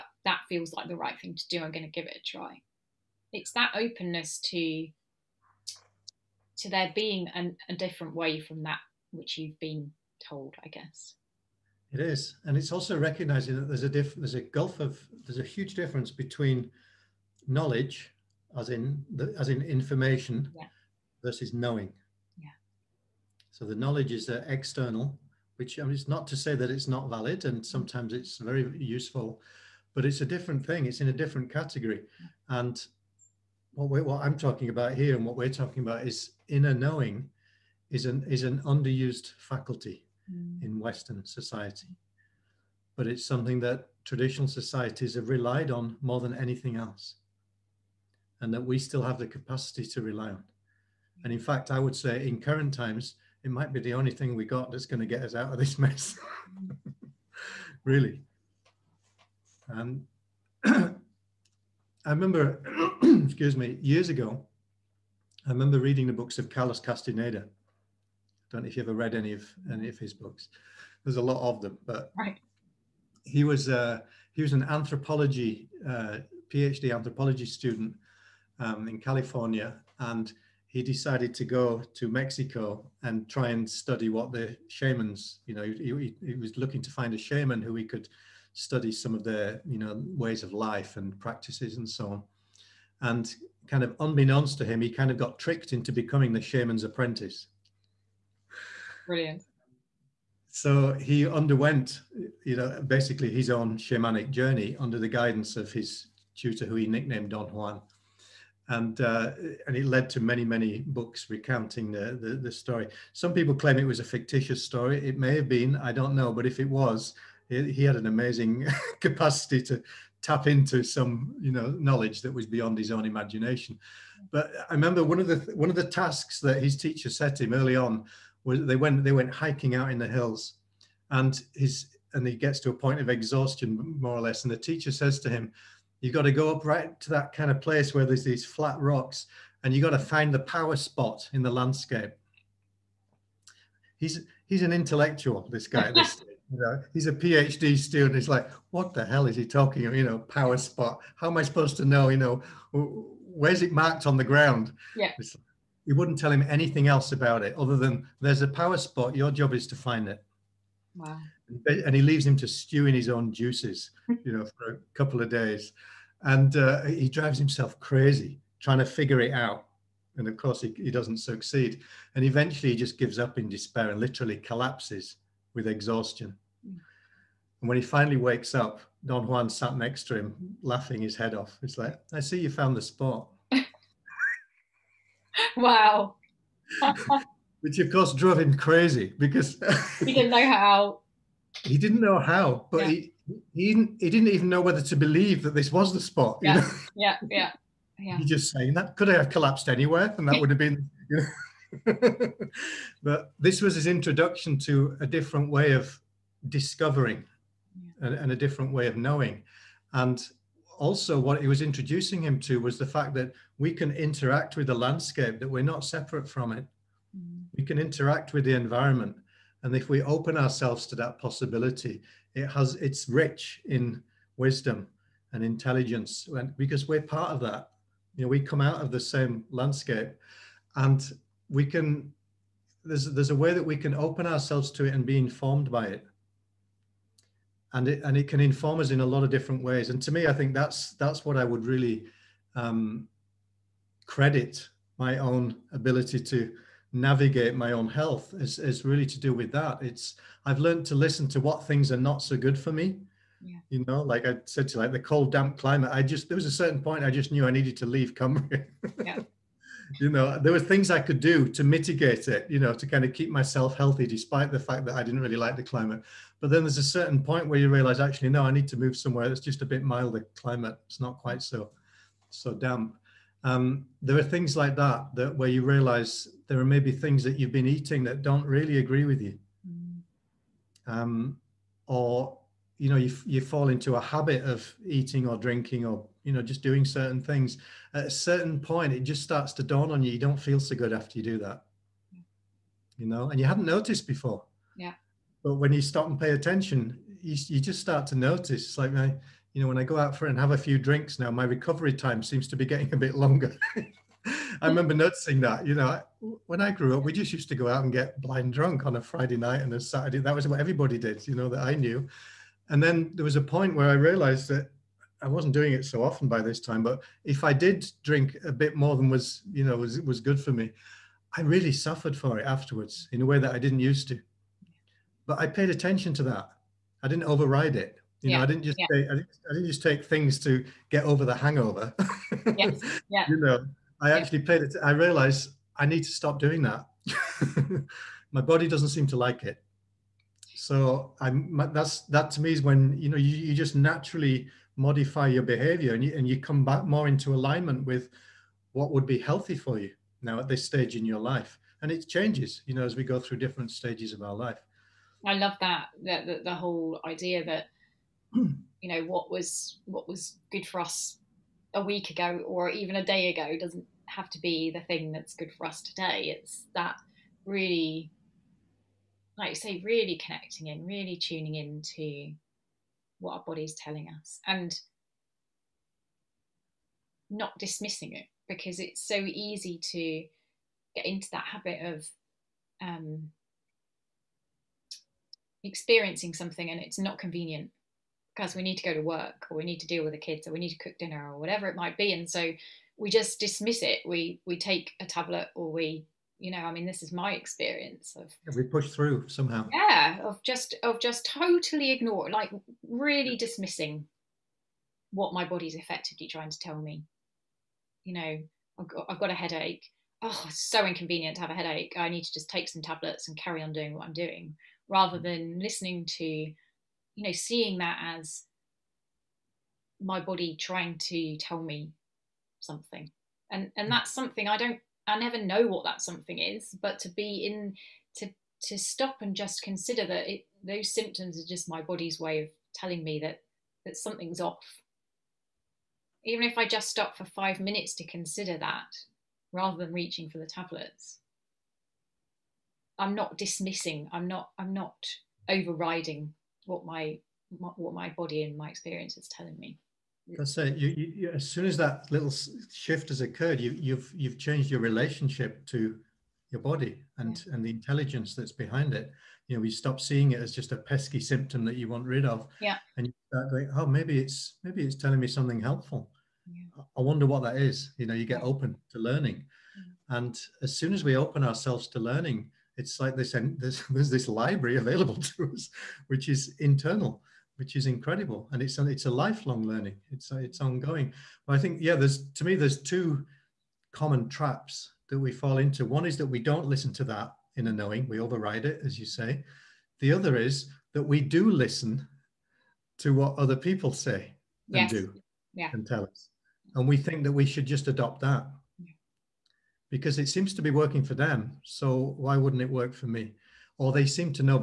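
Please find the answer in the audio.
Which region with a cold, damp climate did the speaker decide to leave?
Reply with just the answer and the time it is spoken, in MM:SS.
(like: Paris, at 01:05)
Cumbria, at 04:18.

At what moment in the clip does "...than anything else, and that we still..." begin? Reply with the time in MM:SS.
00:46.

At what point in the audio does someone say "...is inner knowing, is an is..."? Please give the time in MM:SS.
00:36.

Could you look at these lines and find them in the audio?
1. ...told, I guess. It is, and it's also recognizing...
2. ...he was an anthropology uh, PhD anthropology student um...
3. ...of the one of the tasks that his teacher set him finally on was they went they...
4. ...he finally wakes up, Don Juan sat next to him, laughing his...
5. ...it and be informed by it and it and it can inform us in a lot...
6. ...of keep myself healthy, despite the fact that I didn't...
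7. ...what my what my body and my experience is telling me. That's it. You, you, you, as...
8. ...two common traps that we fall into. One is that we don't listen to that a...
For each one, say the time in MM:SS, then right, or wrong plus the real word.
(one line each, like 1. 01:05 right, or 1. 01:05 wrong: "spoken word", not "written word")
1. 00:10 right
2. 01:14 right
3. 02:05 wrong: "early", not "finally"
4. 02:57 right
5. 03:54 right
6. 04:23 right
7. 07:26 right
8. 08:02 right.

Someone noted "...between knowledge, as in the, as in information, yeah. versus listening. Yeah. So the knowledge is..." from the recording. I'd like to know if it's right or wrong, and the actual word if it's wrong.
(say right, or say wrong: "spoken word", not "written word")
wrong: "knowing", not "listening".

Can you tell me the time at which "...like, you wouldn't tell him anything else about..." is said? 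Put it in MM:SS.
02:35.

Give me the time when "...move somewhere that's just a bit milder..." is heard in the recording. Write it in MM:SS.
04:28.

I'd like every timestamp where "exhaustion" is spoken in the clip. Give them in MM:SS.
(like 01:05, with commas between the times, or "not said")
02:13, 02:55.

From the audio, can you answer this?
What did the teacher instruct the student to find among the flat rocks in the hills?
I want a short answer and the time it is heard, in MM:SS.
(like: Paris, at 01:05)
the power spot, at 02:20.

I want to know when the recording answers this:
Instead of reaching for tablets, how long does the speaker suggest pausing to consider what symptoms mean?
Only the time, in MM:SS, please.
07:17.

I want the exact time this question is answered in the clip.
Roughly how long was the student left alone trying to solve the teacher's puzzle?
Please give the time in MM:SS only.
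02:44.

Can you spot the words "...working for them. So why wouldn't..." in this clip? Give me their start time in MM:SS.
08:20.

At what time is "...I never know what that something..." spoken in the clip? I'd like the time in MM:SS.
07:05.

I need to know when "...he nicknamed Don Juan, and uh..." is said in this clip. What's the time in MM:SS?
01:46.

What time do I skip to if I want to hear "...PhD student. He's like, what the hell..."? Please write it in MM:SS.
02:27.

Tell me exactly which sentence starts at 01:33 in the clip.
And kind of unbeknownst to him, he kind of got tricked into becoming the shaman's apprentice brilliant.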